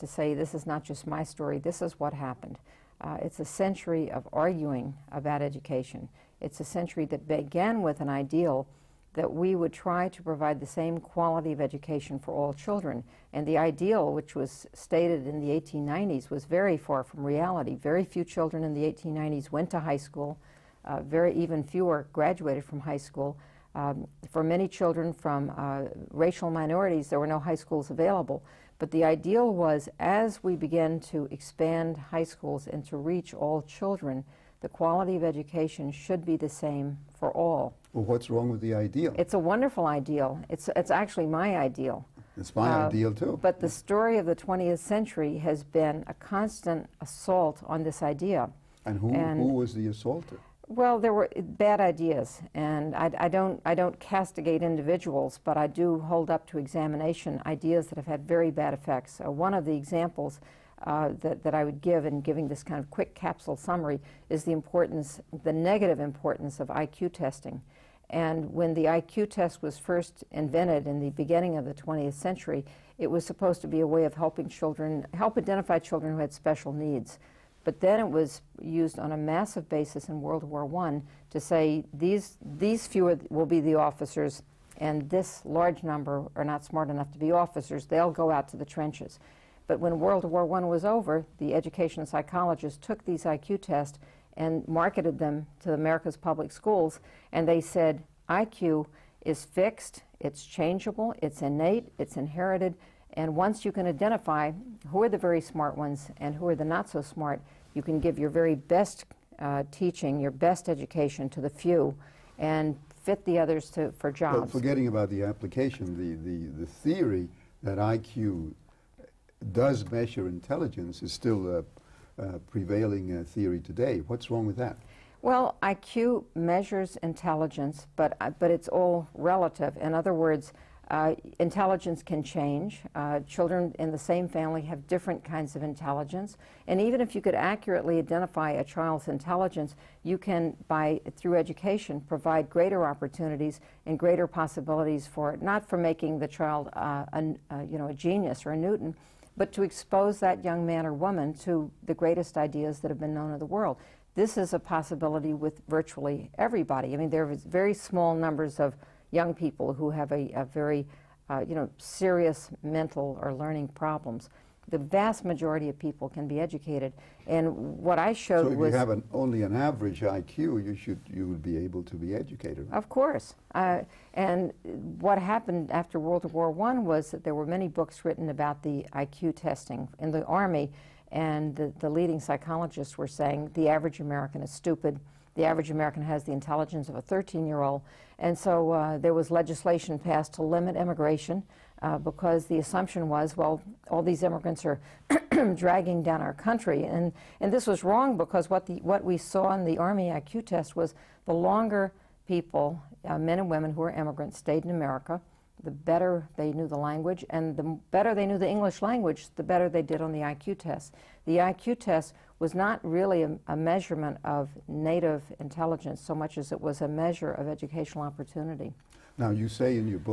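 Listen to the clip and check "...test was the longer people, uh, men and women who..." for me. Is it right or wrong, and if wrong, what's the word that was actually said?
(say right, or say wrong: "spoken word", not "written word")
right.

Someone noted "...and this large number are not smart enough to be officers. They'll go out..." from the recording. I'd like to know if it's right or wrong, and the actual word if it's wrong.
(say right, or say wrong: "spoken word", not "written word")
right.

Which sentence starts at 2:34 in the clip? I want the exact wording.
This is a possibility with virtually everybody.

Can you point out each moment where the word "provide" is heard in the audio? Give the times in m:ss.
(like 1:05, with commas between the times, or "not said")
0:10, 2:22.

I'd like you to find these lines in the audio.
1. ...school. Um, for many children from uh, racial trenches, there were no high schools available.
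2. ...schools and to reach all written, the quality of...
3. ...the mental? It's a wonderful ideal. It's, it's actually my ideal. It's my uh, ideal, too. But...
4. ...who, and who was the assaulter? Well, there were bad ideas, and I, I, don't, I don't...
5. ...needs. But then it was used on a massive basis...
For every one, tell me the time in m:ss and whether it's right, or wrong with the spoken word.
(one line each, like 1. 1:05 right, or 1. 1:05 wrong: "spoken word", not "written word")
1. 0:22 wrong: "minorities", not "trenches"
2. 0:32 wrong: "children", not "written"
3. 0:38 wrong: "ideal", not "mental"
4. 0:48 right
5. 1:16 right.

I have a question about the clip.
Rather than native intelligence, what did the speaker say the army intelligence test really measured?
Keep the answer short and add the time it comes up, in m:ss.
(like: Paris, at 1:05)
educational opportunity, at 3:37.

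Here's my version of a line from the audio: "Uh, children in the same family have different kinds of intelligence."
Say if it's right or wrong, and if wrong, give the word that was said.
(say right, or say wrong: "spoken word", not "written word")
right.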